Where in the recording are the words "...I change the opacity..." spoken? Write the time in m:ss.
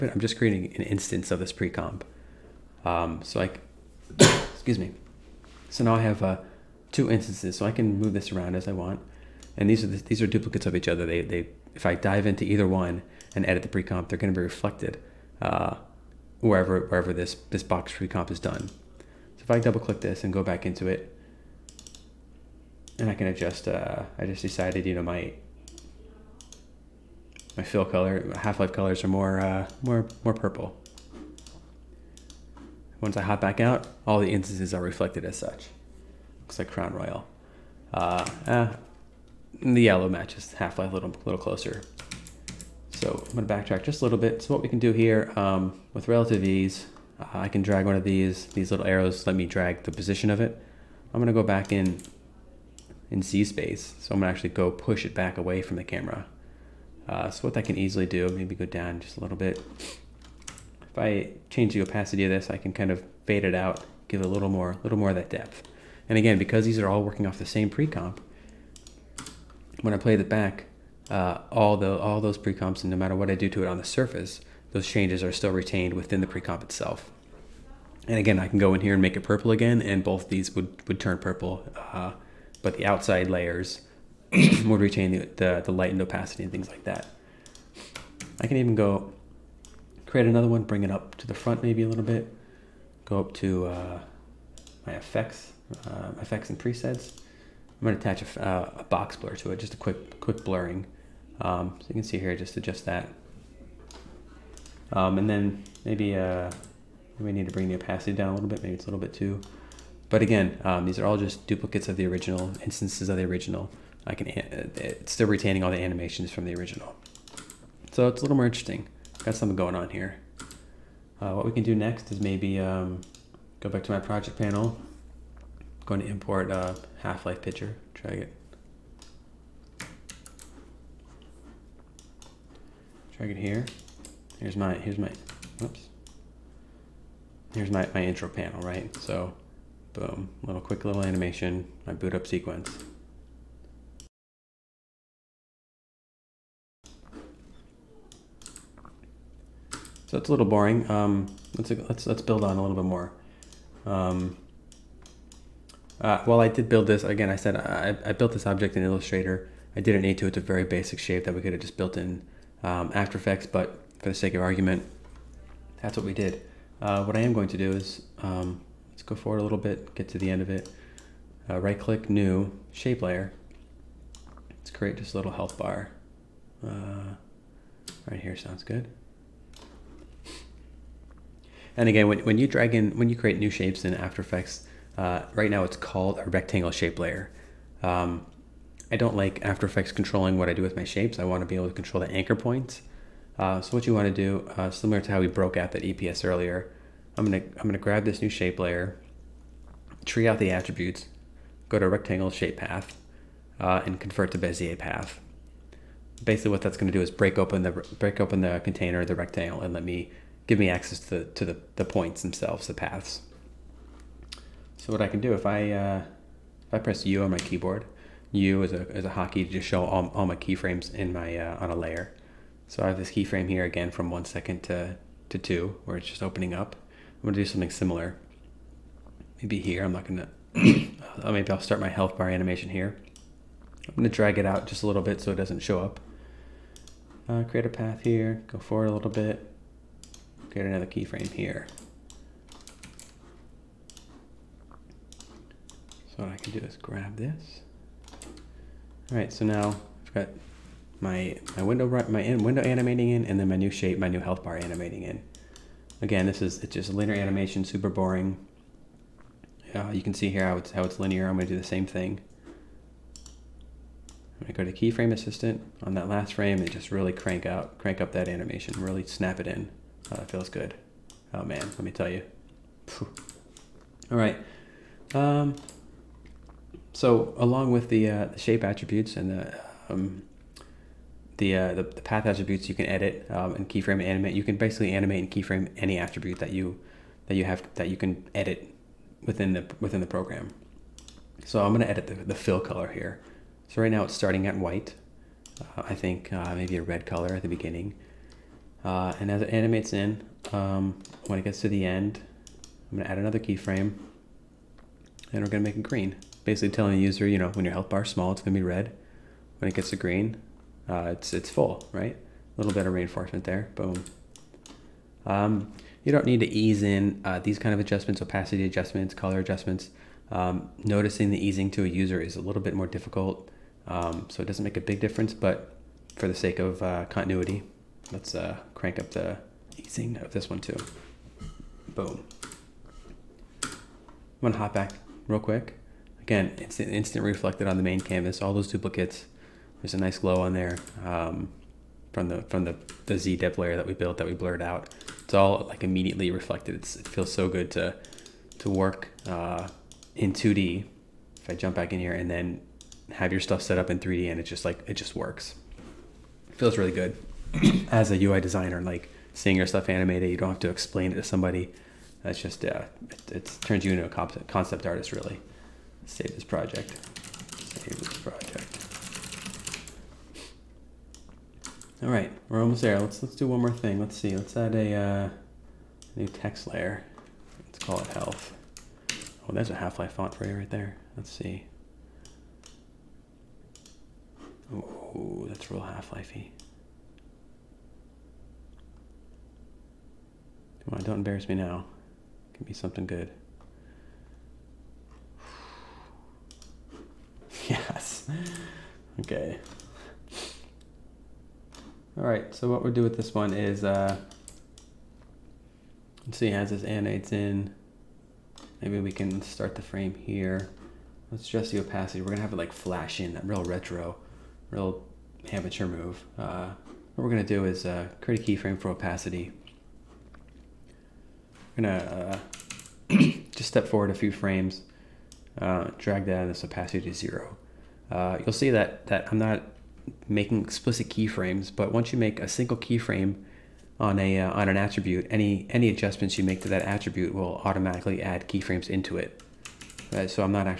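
1:00.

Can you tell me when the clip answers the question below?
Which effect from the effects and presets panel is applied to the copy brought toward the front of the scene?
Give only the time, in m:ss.
1:38.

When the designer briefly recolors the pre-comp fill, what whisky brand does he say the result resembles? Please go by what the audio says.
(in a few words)
Crown Royal.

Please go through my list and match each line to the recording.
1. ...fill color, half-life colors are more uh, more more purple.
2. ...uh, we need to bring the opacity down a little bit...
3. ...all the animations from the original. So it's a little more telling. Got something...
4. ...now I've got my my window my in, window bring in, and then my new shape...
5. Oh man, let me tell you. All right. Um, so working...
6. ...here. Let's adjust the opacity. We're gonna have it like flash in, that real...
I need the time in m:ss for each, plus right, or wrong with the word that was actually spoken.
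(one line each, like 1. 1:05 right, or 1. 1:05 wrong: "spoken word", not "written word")
1. 0:27 right
2. 1:46 right
3. 1:55 wrong: "interesting", not "telling"
4. 4:09 wrong: "animating", not "bring"
5. 4:31 wrong: "along", not "working"
6. 6:50 right.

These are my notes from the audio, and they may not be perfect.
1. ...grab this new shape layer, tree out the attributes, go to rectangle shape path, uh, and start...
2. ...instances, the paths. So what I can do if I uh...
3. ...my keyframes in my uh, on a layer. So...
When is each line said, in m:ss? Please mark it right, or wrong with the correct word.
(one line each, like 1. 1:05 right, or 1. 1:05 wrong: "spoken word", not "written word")
1. 3:17 wrong: "convert", not "start"
2. 3:32 wrong: "themselves", not "instances"
3. 3:40 right.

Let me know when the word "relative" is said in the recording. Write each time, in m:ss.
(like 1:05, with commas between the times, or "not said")
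0:46.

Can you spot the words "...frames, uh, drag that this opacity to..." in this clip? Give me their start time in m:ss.
7:04.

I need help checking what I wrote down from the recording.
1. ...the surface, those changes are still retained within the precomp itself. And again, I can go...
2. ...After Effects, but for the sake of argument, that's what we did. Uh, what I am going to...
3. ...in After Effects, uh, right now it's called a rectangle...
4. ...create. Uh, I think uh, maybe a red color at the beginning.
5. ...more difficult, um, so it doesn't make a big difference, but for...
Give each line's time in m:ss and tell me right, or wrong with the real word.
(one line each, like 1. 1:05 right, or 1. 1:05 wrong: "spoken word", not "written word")
1. 1:13 right
2. 2:42 right
3. 3:03 right
4. 4:54 wrong: "white", not "create"
5. 5:22 right.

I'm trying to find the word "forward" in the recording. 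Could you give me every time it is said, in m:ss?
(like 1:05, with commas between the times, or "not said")
2:49, 3:58, 7:03.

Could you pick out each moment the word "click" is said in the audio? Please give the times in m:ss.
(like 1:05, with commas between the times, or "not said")
0:19, 2:51.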